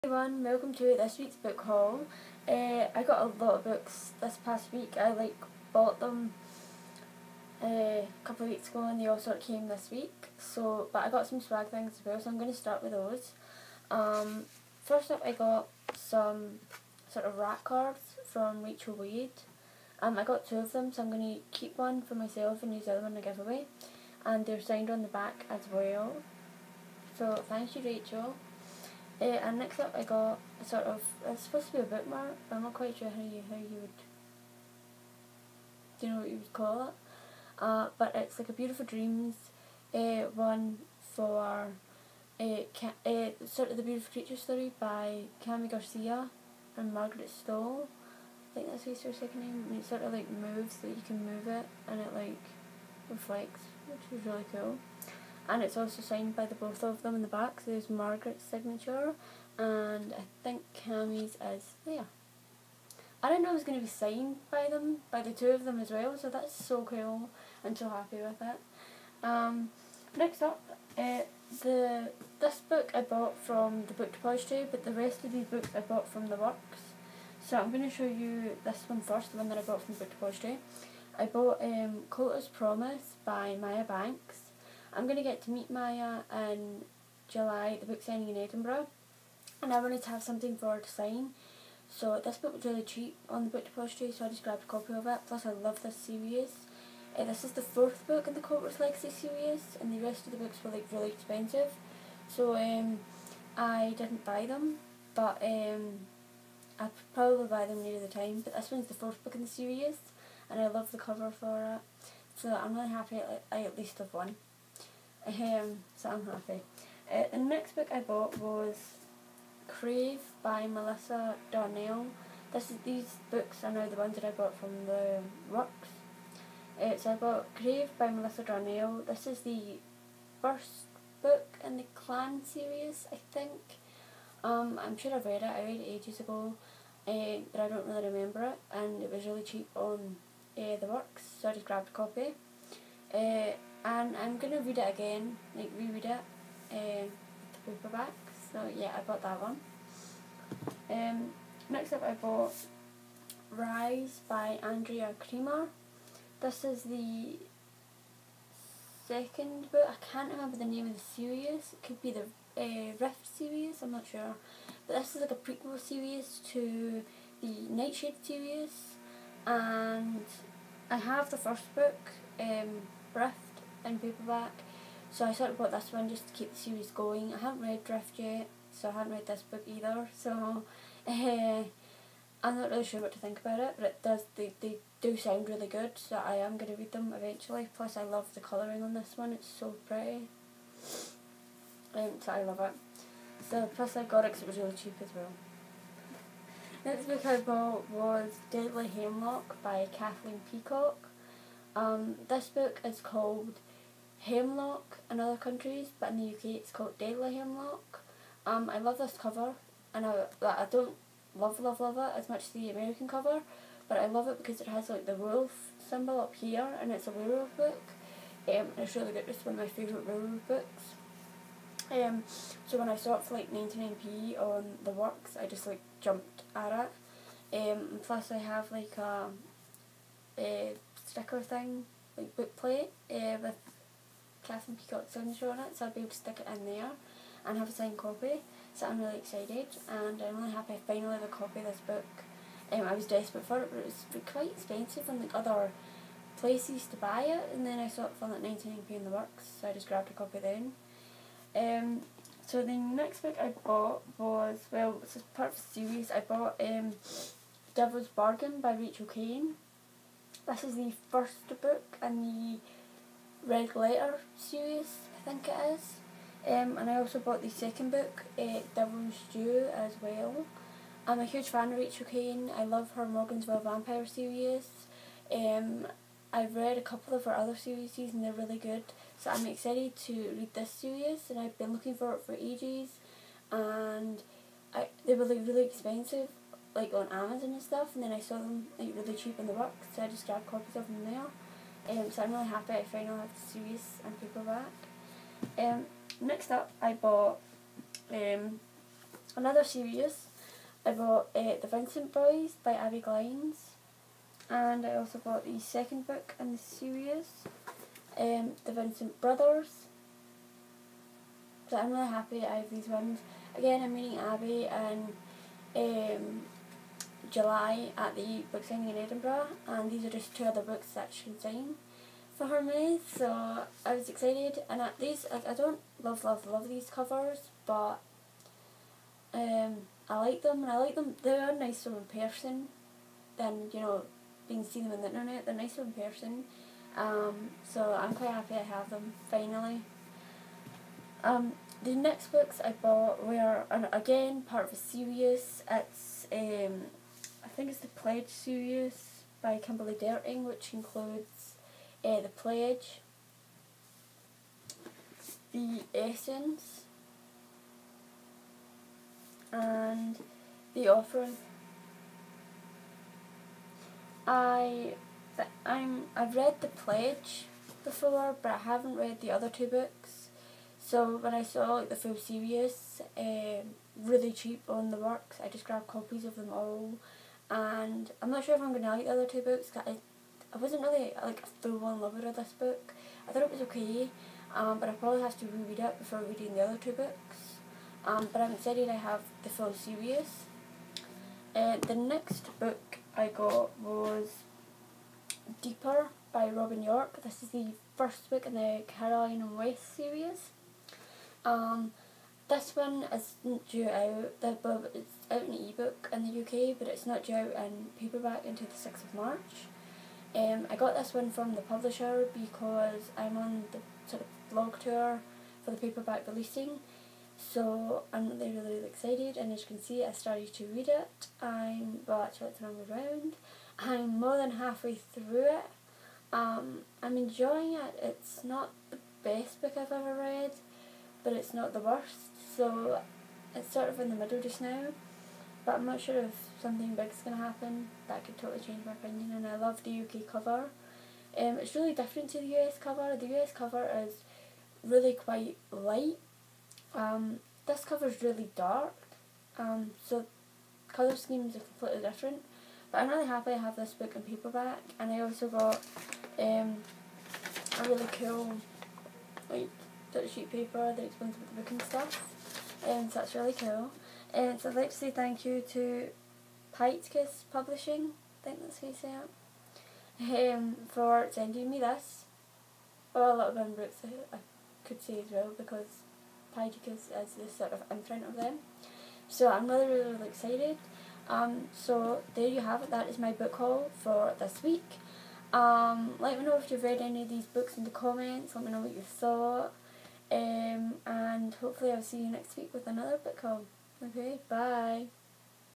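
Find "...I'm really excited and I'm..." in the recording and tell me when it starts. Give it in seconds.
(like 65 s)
238 s.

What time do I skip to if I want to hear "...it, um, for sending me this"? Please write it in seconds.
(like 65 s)
470 s.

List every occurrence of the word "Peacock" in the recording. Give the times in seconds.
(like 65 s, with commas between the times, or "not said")
200 s, 234 s.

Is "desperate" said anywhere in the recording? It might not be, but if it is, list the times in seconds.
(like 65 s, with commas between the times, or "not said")
243 s.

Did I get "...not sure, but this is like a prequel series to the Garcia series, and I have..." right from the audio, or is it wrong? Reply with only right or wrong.
wrong.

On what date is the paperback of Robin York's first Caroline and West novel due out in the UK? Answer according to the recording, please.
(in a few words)
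6 March.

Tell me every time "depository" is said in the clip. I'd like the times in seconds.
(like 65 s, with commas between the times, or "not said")
74 s, 80 s, 93 s.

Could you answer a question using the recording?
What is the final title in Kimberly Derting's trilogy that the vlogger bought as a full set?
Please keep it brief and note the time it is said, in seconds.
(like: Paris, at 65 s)
The Offering, at 360 s.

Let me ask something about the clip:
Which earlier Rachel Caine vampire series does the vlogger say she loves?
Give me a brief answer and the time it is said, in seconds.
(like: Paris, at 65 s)
Morgan's Vampire series, at 273 s.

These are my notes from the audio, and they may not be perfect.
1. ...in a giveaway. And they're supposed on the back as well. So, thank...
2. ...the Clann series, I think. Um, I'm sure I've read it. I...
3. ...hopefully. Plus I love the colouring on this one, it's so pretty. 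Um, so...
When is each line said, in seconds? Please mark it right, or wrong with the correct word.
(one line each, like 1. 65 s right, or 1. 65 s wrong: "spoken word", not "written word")
1. 23 s wrong: "signed", not "supposed"
2. 131 s right
3. 187 s wrong: "eventually", not "hopefully".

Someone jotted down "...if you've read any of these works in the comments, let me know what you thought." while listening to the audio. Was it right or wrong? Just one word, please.
wrong.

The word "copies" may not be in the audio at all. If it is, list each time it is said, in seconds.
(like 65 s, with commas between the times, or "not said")
290 s, 375 s.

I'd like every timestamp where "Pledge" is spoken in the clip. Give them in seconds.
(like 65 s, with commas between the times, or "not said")
347 s, 352 s, 366 s.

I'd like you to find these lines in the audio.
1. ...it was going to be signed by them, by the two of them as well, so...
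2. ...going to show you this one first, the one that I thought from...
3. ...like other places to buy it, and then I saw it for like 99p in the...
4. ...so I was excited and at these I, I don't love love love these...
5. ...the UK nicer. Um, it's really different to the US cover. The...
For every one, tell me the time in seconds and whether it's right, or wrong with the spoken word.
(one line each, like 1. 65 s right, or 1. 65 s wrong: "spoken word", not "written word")
1. 63 s right
2. 77 s wrong: "bought", not "thought"
3. 245 s right
4. 323 s right
5. 439 s wrong: "cover", not "nicer".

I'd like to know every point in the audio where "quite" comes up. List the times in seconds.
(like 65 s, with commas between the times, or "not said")
32 s, 244 s, 338 s, 445 s.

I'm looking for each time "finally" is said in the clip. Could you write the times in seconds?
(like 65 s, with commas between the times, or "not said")
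240 s, 292 s, 339 s.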